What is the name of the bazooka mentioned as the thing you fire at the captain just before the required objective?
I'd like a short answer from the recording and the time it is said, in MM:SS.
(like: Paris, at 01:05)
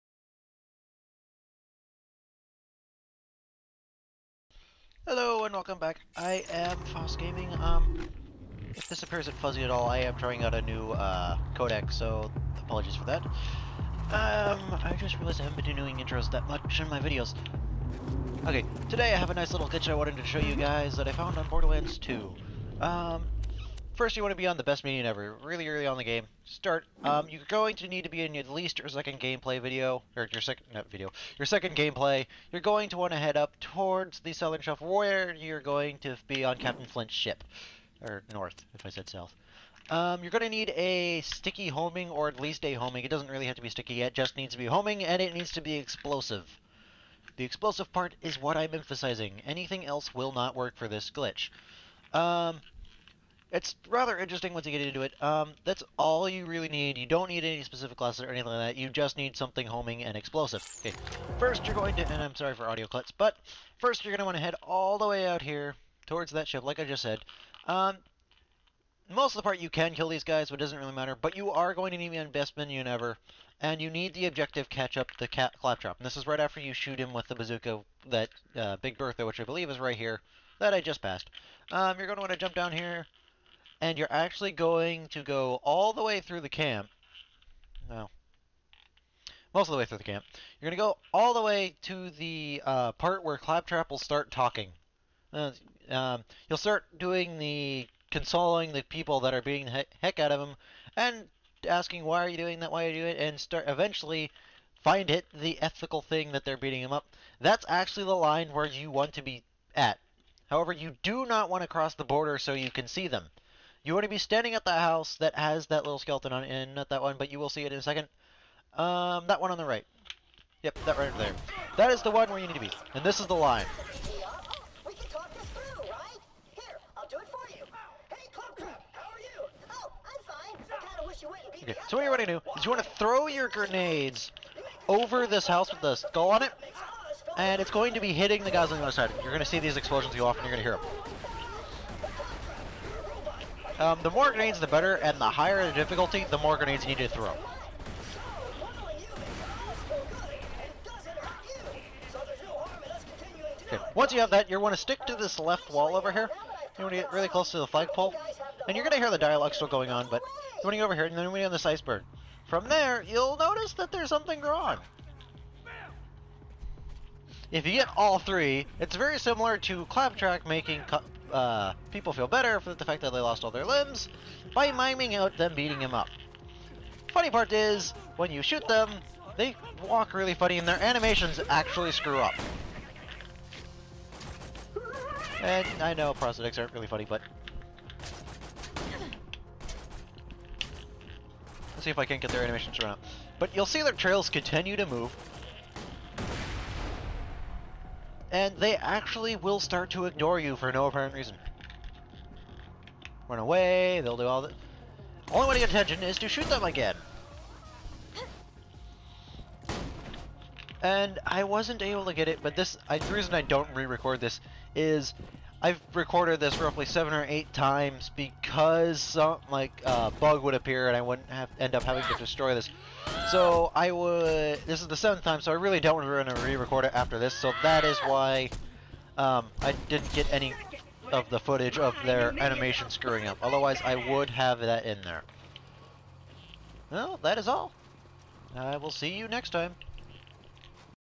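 Big Bertha, at 01:18.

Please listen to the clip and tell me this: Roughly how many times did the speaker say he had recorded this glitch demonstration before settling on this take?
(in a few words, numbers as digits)
7 or 8.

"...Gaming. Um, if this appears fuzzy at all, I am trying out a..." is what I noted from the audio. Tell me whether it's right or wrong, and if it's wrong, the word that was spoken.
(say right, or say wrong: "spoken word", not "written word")
right.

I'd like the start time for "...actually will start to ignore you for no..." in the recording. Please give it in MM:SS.
03:18.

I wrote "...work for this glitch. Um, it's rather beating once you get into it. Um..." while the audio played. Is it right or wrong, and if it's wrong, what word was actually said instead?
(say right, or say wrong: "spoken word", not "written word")
wrong: "interesting", not "beating".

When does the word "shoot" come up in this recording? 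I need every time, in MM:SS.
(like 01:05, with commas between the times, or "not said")
01:16, 02:58, 03:26.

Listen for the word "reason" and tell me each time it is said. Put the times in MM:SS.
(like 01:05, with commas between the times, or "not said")
03:21, 03:33.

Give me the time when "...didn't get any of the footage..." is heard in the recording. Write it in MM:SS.
03:49.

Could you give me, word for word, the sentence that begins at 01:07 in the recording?
Um, most of the part you can kill these guys, but it doesn't really matter.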